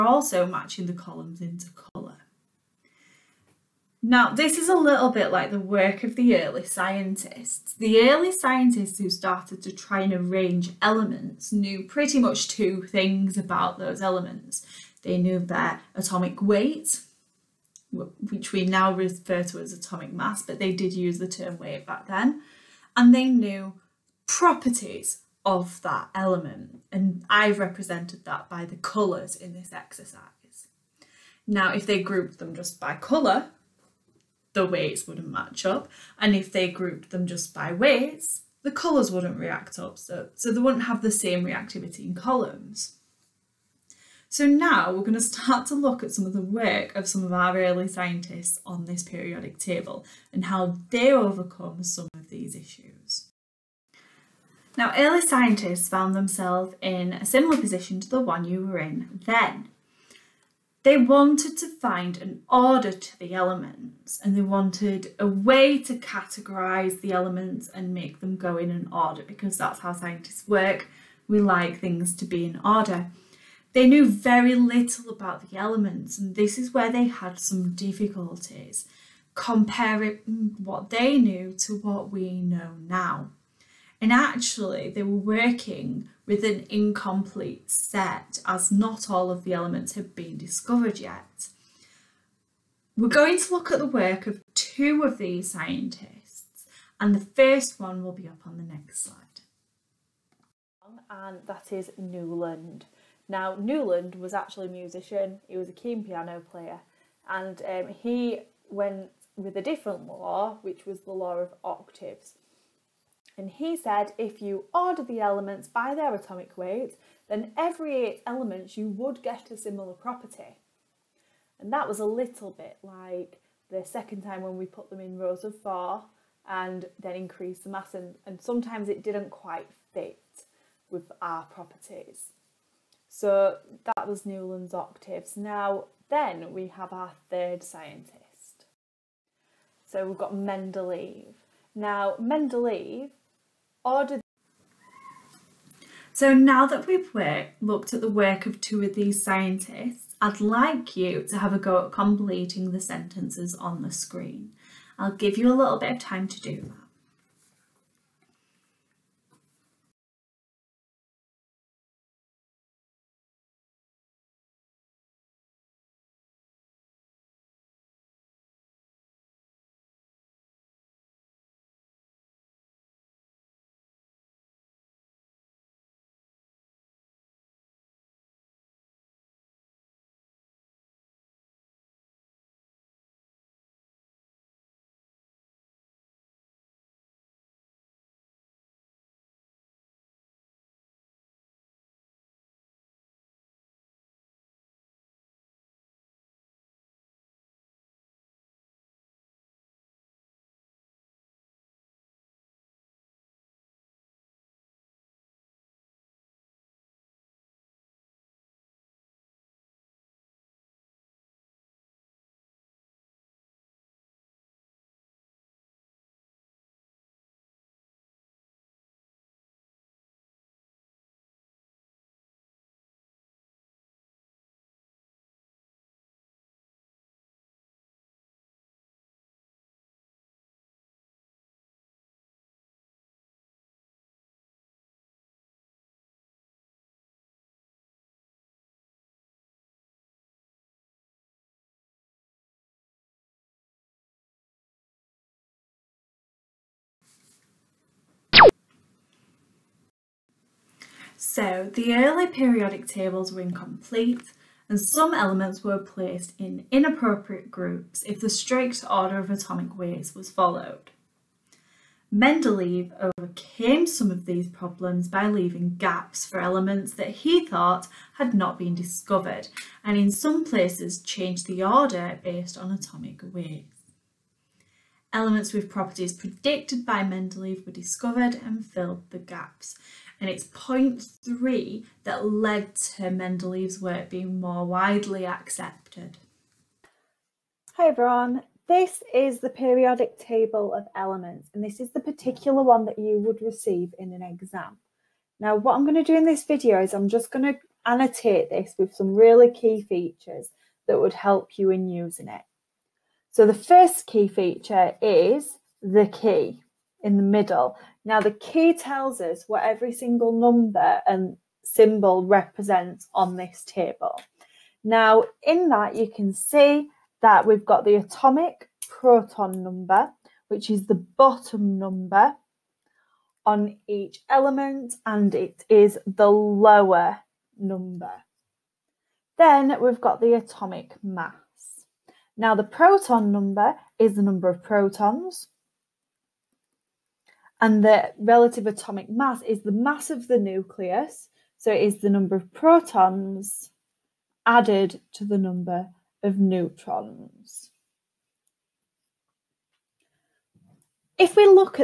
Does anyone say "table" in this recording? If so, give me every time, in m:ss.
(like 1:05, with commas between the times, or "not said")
0:49, 4:12, 4:50, 5:13.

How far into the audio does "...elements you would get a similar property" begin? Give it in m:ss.
1:58.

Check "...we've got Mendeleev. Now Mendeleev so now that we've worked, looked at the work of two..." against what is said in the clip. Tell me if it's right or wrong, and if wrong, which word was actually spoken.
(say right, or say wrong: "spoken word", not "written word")
right.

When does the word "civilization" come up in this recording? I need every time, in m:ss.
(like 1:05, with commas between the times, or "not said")
not said.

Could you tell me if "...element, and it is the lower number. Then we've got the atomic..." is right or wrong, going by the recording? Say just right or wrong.
right.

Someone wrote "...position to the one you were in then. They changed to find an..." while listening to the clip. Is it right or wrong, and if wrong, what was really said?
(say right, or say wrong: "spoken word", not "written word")
wrong: "wanted", not "changed".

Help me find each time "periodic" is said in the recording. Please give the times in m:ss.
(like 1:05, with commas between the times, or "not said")
0:49, 4:12, 4:49.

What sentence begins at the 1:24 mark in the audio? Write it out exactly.
And actually, they were working with an incomplete set as not all of the elements have been discovered yet.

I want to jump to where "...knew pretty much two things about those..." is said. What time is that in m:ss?
0:11.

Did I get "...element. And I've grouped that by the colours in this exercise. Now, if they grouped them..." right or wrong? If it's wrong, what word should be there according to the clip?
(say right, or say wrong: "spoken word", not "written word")
wrong: "represented", not "grouped".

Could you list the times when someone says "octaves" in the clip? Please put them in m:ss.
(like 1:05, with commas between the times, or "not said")
1:51, 2:14.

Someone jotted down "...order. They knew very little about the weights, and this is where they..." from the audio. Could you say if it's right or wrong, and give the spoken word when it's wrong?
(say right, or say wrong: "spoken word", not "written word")
wrong: "elements", not "weights".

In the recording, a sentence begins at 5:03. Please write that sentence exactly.
So the first key feature is the key in the middle.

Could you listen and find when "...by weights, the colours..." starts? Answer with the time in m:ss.
0:37.